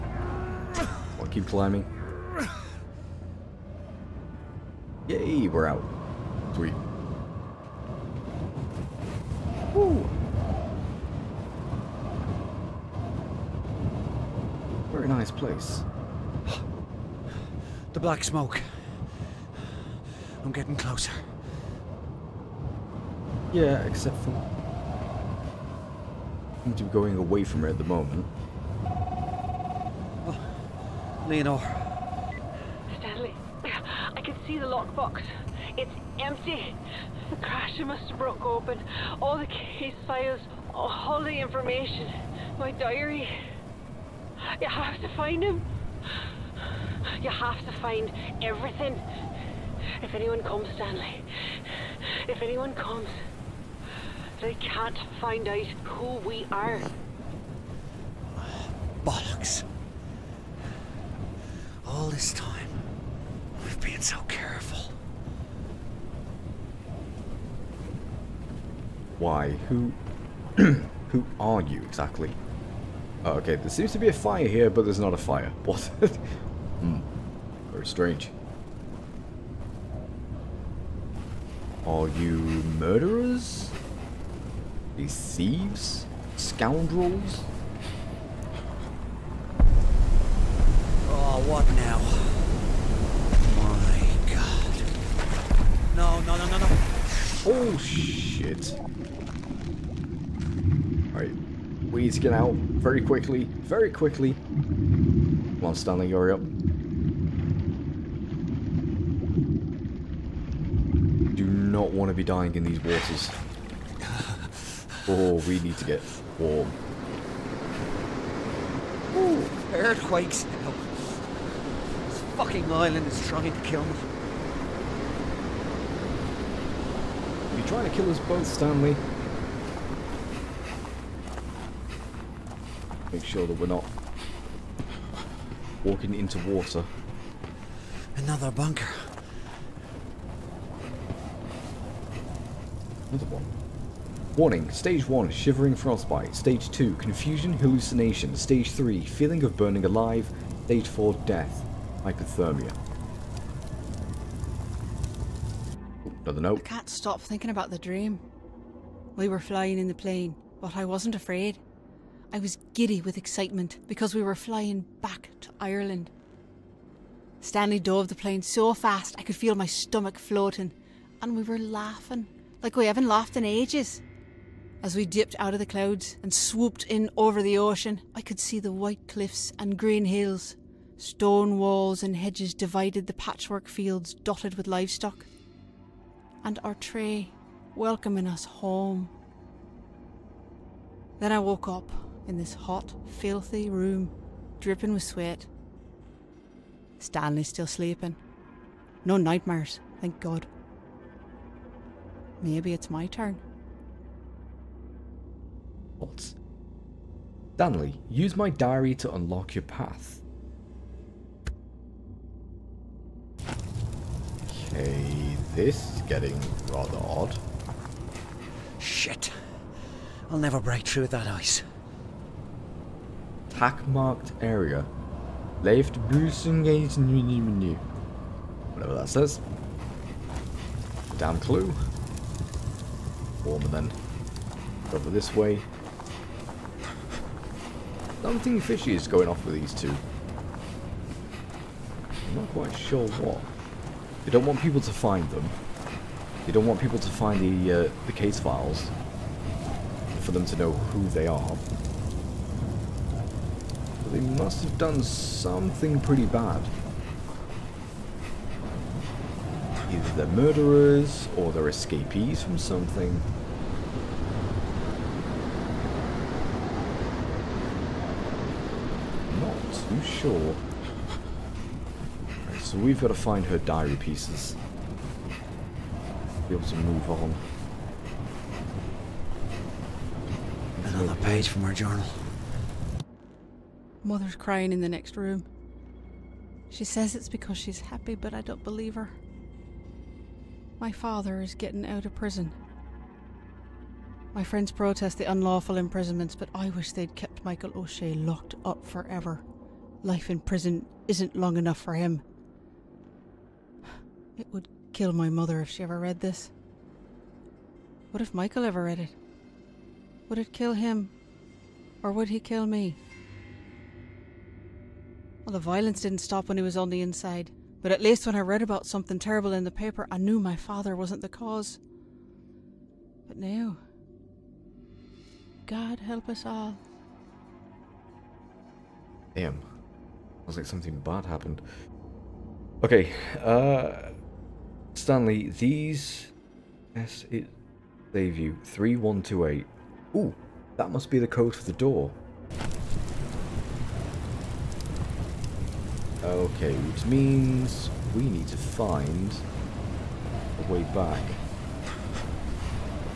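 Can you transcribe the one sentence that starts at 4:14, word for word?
They must have done something pretty bad.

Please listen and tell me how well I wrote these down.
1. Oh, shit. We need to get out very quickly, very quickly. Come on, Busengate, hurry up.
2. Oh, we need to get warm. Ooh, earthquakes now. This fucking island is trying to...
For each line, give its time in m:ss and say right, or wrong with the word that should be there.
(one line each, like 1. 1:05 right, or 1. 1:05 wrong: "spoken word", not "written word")
1. 1:37 wrong: "Stanley", not "Busengate"
2. 1:55 right.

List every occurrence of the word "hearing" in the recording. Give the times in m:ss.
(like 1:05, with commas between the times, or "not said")
not said.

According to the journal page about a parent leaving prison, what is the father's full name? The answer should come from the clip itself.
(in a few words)
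Michael O'Shea.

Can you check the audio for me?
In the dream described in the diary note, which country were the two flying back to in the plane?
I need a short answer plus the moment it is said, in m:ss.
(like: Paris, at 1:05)
Ireland, at 2:45.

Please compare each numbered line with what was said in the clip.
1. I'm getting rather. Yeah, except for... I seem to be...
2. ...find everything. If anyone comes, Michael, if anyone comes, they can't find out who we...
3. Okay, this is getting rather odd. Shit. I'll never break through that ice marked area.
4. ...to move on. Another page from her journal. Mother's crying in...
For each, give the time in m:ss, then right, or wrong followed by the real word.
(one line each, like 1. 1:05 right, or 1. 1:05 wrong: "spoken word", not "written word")
1. 0:20 wrong: "closer", not "rather"
2. 0:47 wrong: "Stanley", not "Michael"
3. 3:34 right
4. 4:36 right.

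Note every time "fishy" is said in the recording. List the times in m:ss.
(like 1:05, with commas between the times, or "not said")
3:58.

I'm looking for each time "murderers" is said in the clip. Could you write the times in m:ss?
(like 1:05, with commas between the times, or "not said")
1:22, 4:20.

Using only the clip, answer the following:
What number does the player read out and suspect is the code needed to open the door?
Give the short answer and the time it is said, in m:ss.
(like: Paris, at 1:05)
3128, at 5:38.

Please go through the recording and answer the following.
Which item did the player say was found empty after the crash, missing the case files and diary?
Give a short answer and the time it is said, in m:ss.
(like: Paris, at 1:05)
The lockbox, at 0:34.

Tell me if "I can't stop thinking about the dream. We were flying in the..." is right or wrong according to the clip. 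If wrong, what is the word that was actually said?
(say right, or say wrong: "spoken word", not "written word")
right.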